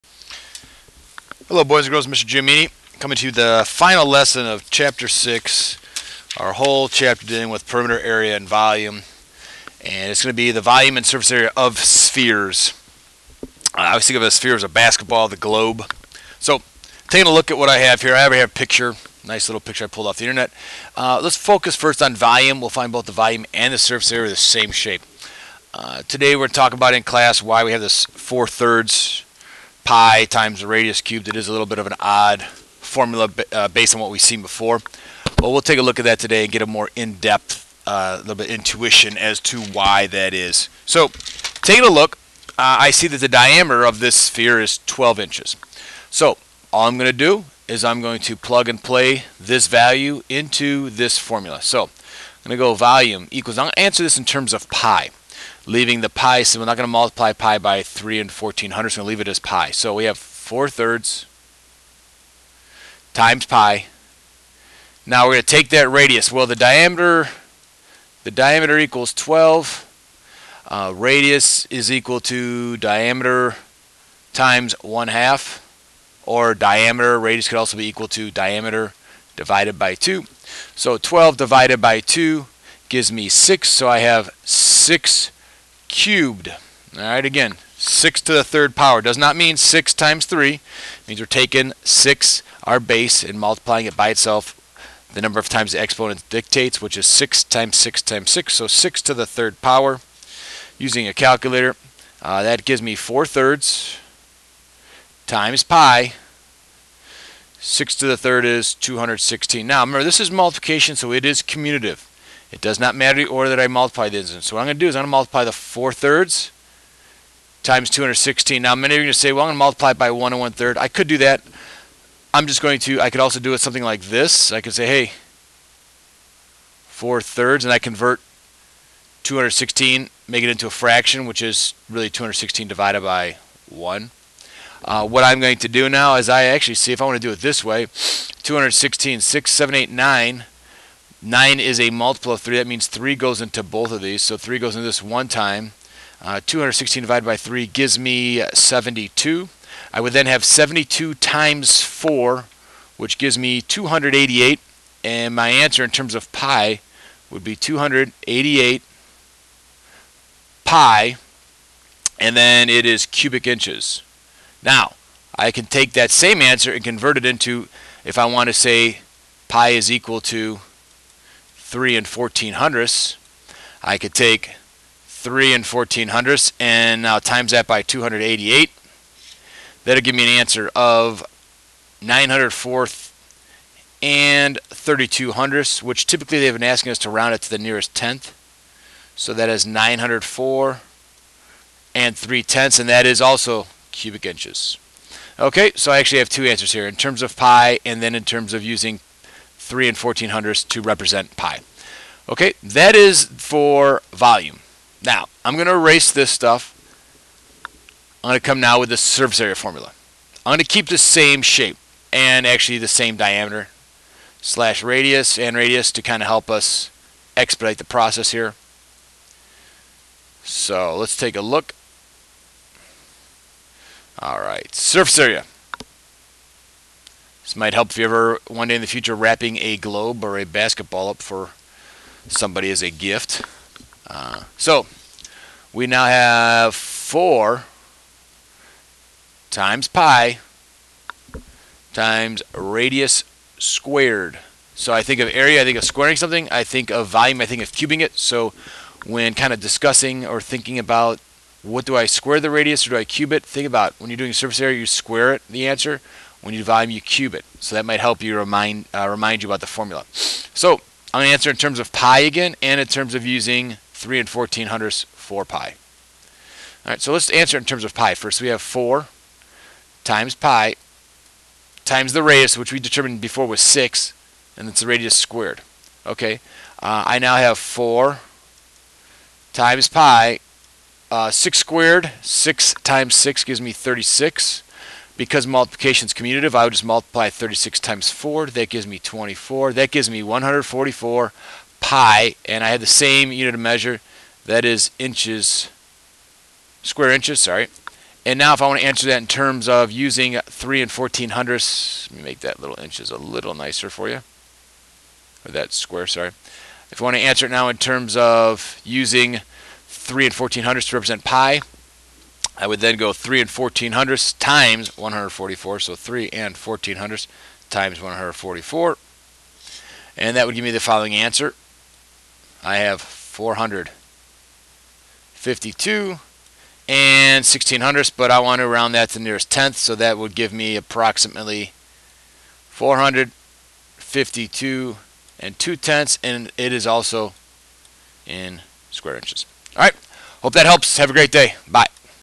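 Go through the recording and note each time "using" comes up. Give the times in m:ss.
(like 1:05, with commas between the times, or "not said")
1:40, 3:18, 4:23, 4:59, 5:08.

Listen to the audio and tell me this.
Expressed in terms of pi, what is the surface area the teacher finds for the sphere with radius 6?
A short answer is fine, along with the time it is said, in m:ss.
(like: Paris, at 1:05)
144 pi, at 4:50.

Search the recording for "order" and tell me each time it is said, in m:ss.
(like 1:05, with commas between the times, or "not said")
1:53.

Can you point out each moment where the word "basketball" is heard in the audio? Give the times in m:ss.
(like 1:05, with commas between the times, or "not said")
0:14, 3:50.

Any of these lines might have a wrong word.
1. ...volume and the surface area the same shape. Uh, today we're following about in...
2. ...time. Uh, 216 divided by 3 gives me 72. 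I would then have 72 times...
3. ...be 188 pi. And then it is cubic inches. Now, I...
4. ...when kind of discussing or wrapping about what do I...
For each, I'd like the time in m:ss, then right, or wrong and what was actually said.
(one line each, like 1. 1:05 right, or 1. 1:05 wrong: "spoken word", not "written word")
1. 0:23 wrong: "talking", not "following"
2. 2:25 right
3. 2:37 wrong: "288", not "188"
4. 4:09 wrong: "thinking", not "wrapping".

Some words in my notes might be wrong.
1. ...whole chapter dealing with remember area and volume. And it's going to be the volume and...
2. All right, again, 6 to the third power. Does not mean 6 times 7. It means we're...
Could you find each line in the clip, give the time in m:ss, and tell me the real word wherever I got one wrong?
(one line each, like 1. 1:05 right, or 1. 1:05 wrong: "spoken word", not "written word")
1. 0:06 wrong: "perimeter", not "remember"
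2. 1:26 wrong: "3", not "7".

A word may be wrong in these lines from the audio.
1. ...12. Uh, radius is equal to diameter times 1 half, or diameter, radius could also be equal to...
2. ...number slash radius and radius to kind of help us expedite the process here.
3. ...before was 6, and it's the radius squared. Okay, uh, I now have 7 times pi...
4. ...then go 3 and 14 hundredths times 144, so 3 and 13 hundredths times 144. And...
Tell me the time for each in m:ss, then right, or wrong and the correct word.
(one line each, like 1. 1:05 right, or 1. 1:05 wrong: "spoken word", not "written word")
1. 1:09 right
2. 3:33 wrong: "diameter", not "number"
3. 4:33 wrong: "4", not "7"
4. 5:12 wrong: "14", not "13".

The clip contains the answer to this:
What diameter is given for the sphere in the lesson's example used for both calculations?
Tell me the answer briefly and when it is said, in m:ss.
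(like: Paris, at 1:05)
12 inches, at 0:44.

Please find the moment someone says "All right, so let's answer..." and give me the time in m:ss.
4:26.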